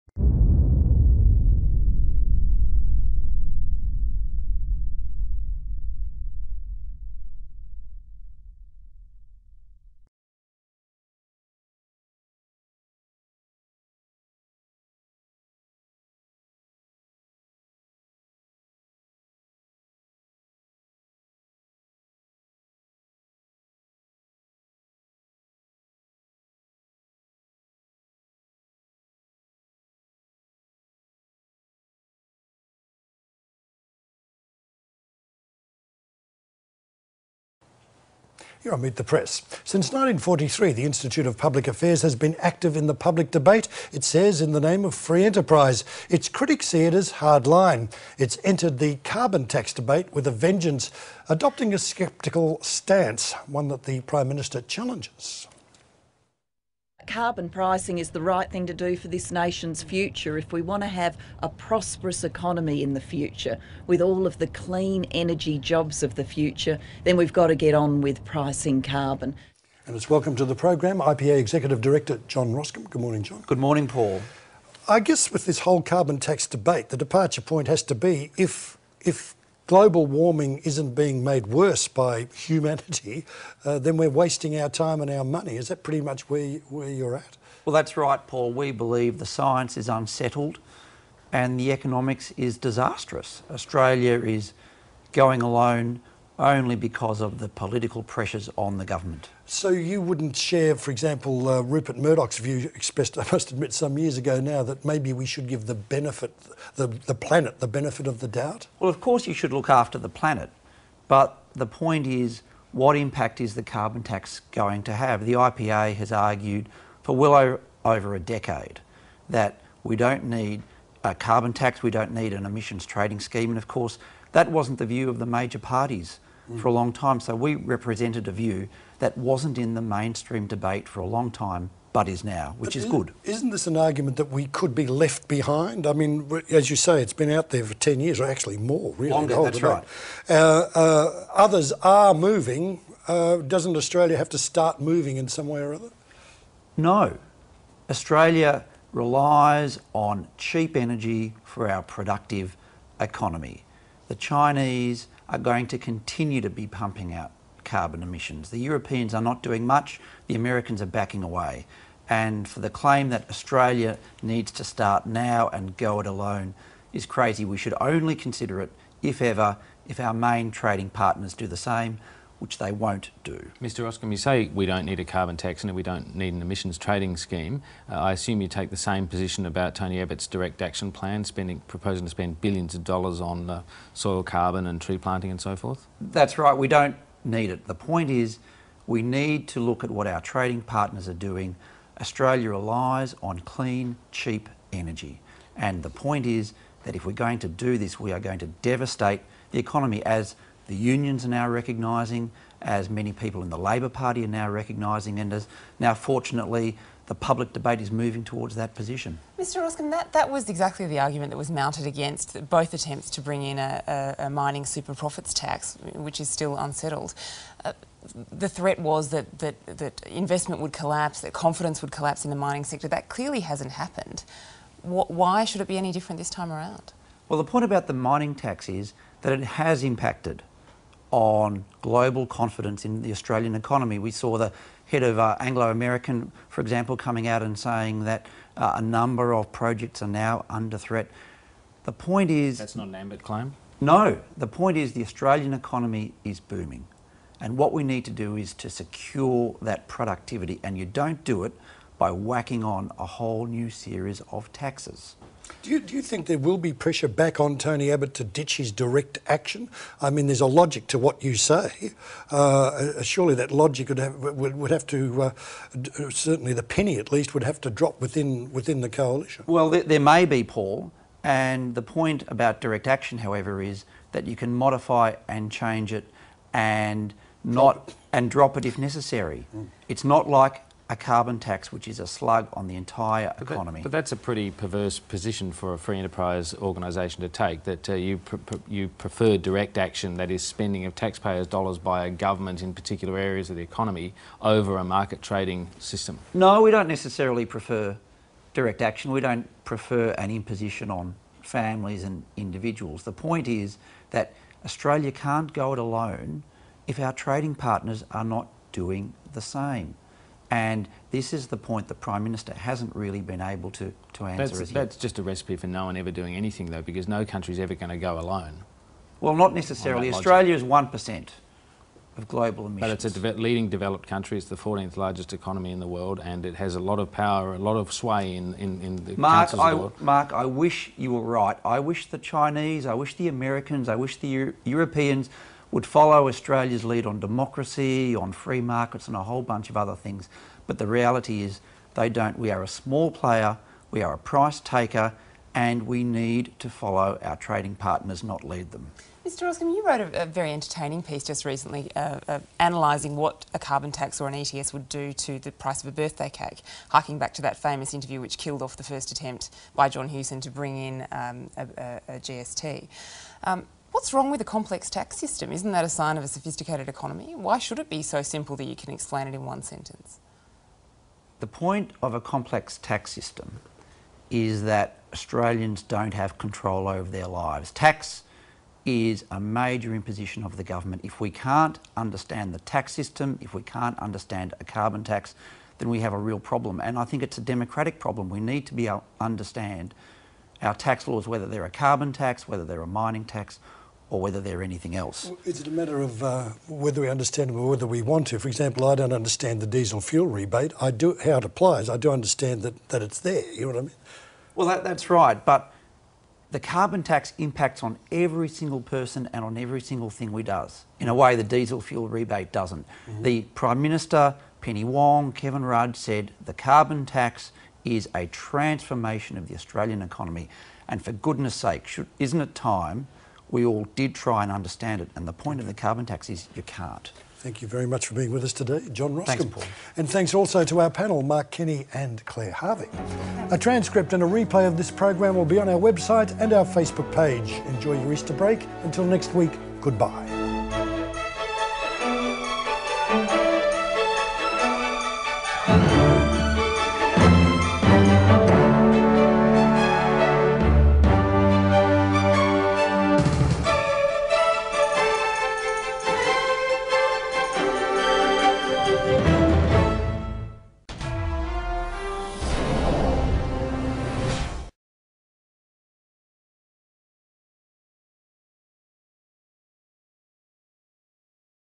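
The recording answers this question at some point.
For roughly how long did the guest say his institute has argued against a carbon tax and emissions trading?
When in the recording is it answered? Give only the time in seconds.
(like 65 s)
117 s.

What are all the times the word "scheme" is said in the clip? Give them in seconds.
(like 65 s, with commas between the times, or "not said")
123 s, 177 s.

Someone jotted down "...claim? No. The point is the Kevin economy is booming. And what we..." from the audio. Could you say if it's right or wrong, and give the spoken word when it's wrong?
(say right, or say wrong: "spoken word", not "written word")
wrong: "Australian", not "Kevin".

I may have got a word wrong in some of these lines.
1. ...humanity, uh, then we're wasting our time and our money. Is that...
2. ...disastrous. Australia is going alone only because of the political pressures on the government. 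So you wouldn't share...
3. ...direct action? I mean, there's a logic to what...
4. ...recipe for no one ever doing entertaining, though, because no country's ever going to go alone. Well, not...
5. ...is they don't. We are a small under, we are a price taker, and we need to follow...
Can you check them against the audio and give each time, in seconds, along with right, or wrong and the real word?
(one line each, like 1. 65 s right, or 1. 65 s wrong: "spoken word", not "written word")
1. 82 s right
2. 92 s right
3. 258 s right
4. 315 s wrong: "anything", not "entertaining"
5. 341 s wrong: "player", not "under".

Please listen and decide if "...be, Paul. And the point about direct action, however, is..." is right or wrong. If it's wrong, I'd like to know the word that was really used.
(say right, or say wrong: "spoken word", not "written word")
right.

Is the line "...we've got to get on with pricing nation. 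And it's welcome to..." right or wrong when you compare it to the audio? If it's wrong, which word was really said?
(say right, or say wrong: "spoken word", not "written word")
wrong: "carbon", not "nation".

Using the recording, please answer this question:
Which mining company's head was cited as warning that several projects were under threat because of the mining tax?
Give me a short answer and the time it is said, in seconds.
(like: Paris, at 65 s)
Anglo American, at 235 s.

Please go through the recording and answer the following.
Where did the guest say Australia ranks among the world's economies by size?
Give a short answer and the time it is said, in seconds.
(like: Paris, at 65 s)
14th largest, at 324 s.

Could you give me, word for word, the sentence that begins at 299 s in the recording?
We don't prefer an imposition on families and individuals.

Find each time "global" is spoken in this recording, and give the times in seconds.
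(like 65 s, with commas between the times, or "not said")
79 s, 231 s, 322 s.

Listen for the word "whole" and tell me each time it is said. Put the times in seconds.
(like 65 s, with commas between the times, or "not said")
75 s, 253 s, 339 s.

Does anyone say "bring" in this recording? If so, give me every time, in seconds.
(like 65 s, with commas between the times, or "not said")
213 s, 360 s.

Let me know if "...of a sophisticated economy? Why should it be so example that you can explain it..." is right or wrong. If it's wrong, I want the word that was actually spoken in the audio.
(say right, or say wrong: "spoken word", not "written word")
wrong: "simple", not "example".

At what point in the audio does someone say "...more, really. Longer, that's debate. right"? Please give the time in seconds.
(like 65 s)
138 s.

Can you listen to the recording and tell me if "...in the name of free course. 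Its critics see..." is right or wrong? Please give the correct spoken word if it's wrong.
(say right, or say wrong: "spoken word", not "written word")
wrong: "enterprise", not "course".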